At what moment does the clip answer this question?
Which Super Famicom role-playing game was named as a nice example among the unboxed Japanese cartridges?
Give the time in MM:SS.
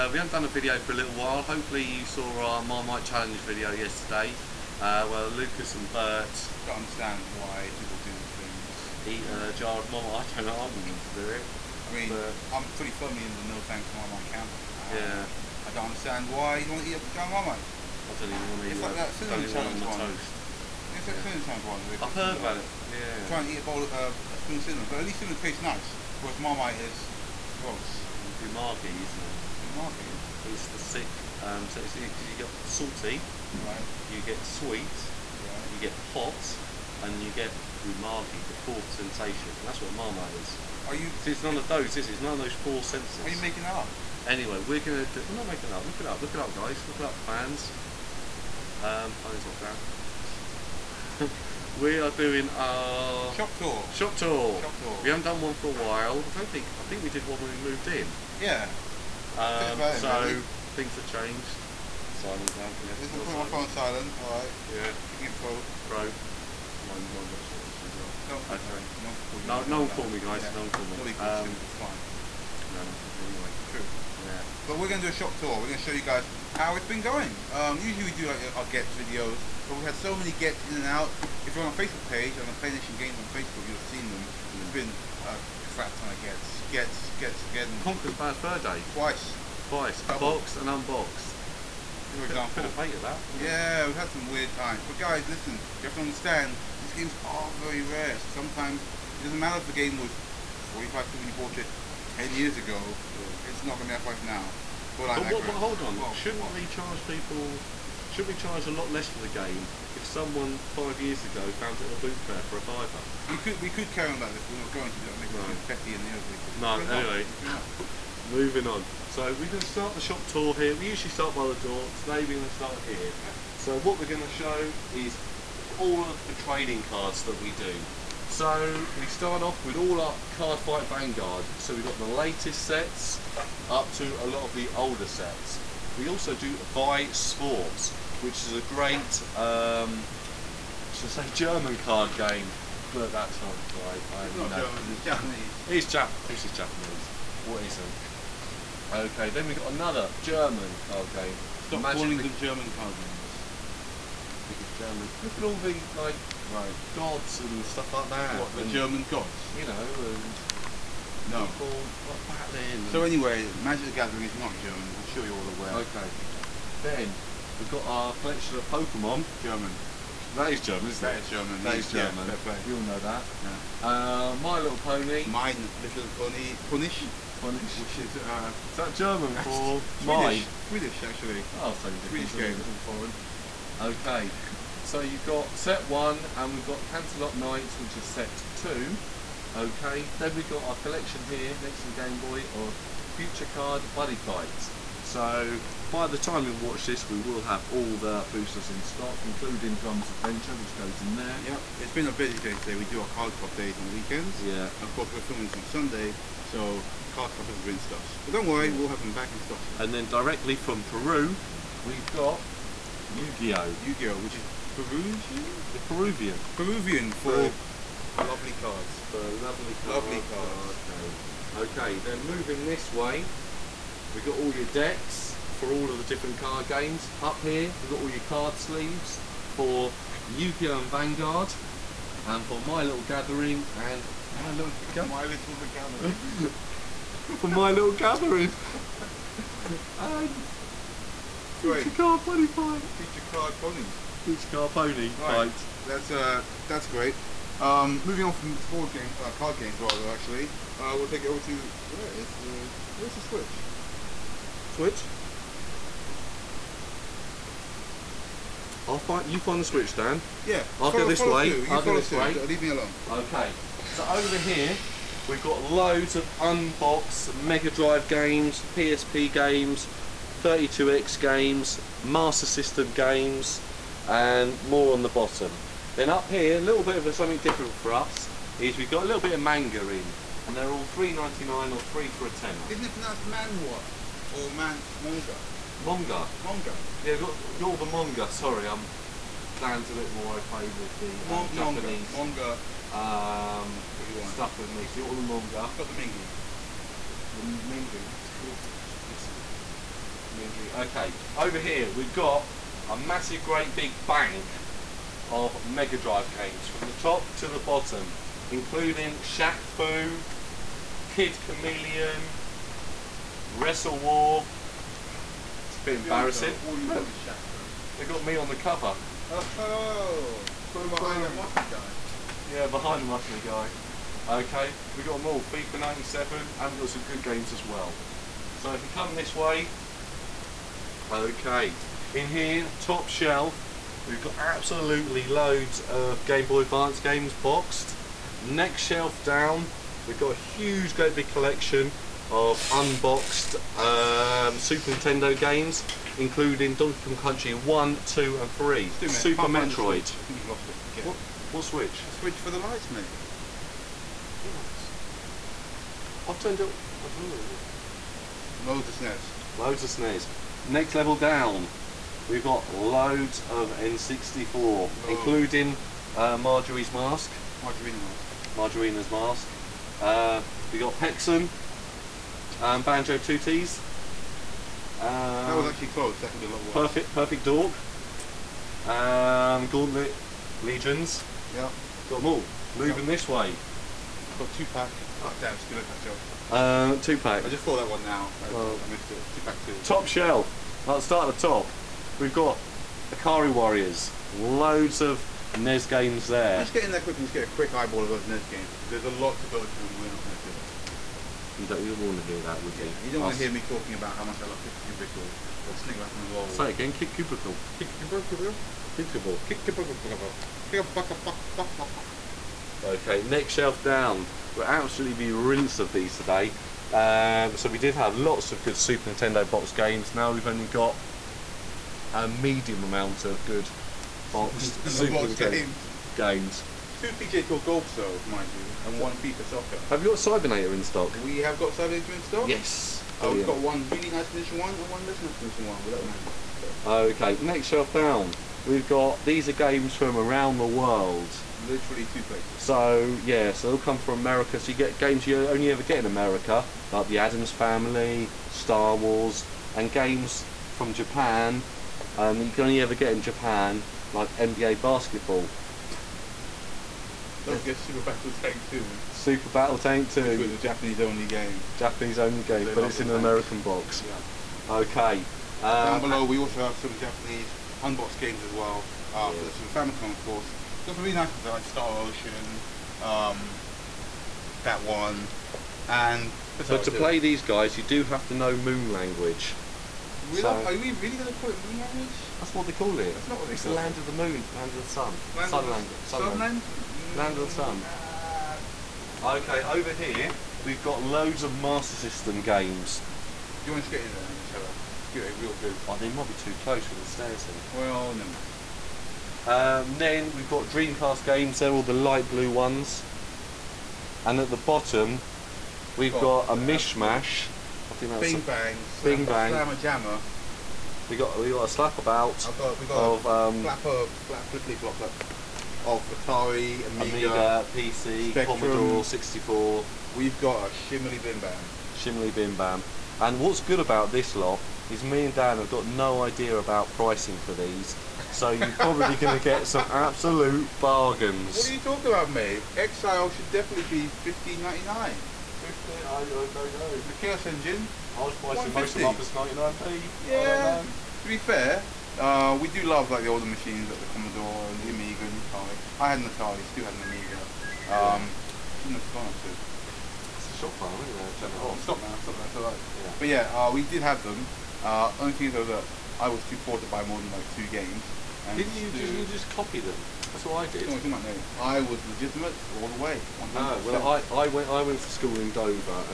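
07:51.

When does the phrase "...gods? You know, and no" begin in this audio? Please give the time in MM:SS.
02:39.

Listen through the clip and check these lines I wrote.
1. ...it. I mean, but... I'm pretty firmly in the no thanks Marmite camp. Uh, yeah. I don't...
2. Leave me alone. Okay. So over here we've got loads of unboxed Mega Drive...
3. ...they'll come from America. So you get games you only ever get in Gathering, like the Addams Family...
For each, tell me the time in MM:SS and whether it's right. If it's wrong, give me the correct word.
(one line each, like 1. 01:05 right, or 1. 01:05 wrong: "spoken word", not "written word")
1. 00:11 right
2. 04:22 right
3. 07:23 wrong: "America", not "Gathering".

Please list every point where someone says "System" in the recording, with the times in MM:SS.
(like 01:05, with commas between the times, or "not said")
04:32, 08:11.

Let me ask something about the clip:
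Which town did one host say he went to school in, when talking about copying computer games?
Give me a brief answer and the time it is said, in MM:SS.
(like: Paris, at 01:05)
Dover, at 09:25.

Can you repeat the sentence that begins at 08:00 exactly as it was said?
So, are we really going to call it moon language?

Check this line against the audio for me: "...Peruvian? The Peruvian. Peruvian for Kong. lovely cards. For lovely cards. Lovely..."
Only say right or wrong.
wrong.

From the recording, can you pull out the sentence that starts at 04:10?
Uh, we'll take it over to where is the where's the switch?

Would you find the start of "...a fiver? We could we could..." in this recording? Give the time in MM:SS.
01:52.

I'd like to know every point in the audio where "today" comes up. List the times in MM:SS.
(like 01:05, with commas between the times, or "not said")
02:01, 03:22, 06:56.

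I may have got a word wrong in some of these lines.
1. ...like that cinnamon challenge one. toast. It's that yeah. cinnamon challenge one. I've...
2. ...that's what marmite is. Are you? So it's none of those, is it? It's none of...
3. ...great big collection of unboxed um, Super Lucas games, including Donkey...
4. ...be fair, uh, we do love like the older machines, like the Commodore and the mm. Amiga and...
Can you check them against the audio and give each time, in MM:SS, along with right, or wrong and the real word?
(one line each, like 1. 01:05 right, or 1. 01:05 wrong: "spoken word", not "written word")
1. 00:18 right
2. 00:39 right
3. 05:40 wrong: "Nintendo", not "Lucas"
4. 09:01 right.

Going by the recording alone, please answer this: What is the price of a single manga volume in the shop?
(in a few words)
3.99.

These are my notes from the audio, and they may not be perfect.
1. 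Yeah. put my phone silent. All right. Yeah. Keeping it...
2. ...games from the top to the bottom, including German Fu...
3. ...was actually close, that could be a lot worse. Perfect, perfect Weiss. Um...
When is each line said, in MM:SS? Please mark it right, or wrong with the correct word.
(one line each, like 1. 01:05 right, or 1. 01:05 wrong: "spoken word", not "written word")
1. 01:02 right
2. 05:06 wrong: "Shaq", not "German"
3. 06:15 wrong: "Dork", not "Weiss".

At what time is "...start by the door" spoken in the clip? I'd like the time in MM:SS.
02:01.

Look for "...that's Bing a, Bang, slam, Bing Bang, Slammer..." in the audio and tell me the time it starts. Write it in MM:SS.
08:28.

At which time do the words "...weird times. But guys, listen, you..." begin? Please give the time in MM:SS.
01:34.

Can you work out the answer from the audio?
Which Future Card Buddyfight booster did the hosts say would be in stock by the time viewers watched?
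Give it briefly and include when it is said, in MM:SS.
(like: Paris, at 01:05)
Drums Adventure, at 03:19.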